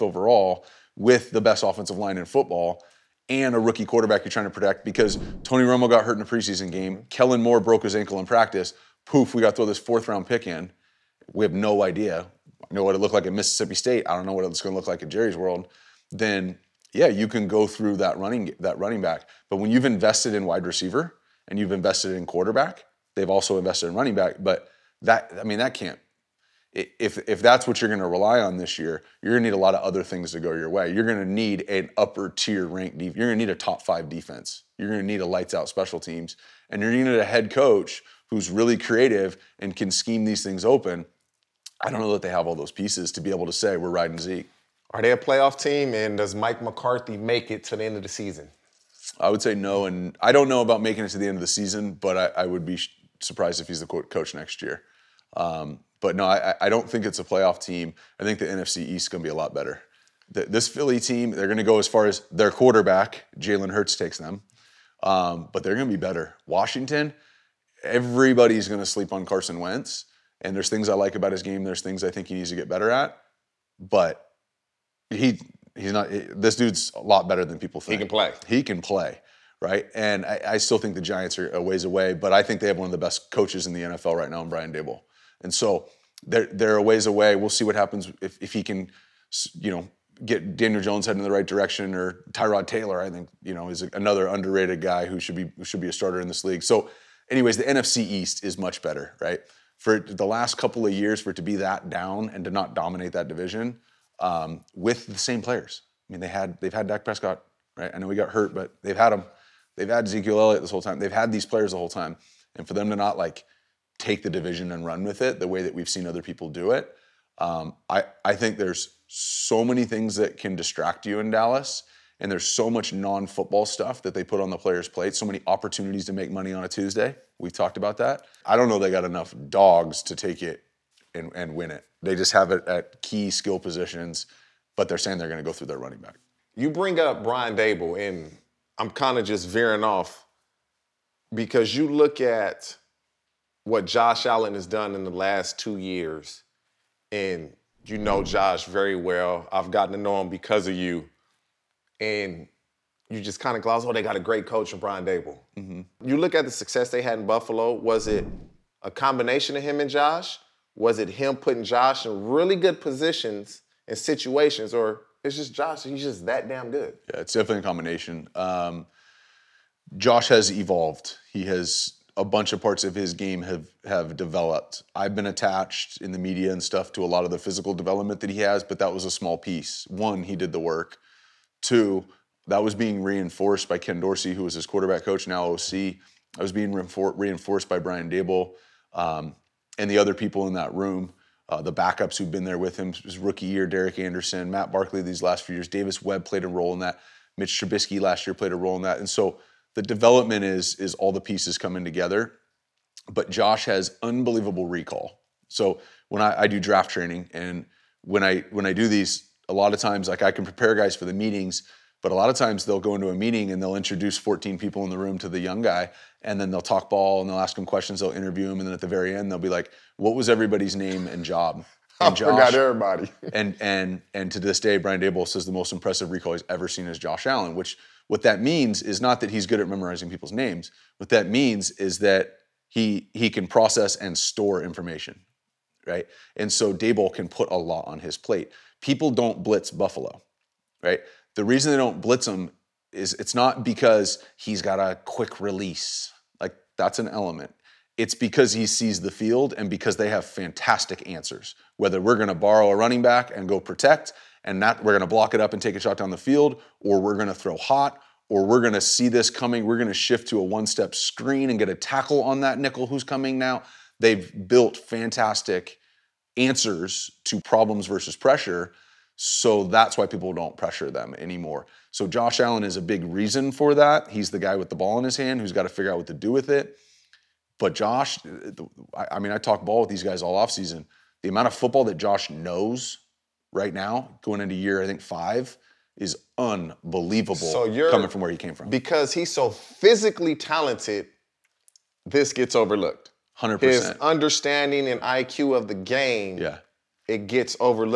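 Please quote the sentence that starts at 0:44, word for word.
Are they a playoff team, and does Mike McCarthy make it to the end of the season?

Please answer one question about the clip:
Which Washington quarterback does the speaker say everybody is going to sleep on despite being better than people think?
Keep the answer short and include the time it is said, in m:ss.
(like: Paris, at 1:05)
Carson Wentz, at 1:09.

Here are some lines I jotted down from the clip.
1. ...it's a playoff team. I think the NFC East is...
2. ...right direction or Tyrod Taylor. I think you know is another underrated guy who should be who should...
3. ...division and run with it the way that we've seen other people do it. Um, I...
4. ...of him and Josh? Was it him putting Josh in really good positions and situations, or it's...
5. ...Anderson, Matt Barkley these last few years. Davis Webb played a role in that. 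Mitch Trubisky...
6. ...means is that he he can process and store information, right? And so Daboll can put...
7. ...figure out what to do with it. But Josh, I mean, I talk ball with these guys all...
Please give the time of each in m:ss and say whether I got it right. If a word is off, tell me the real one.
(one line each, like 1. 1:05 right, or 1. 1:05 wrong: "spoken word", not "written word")
1. 0:57 right
2. 1:31 right
3. 1:54 right
4. 2:39 right
5. 3:13 right
6. 3:51 right
7. 4:35 right.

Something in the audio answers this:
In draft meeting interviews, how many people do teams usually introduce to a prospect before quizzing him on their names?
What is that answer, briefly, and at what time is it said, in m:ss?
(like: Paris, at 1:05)
14, at 3:34.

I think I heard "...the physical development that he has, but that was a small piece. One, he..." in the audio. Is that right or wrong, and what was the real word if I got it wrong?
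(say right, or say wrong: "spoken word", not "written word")
right.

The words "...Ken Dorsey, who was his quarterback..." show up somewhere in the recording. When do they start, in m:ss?
3:03.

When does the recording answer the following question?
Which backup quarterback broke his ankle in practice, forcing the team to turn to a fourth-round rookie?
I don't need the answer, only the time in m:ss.
0:07.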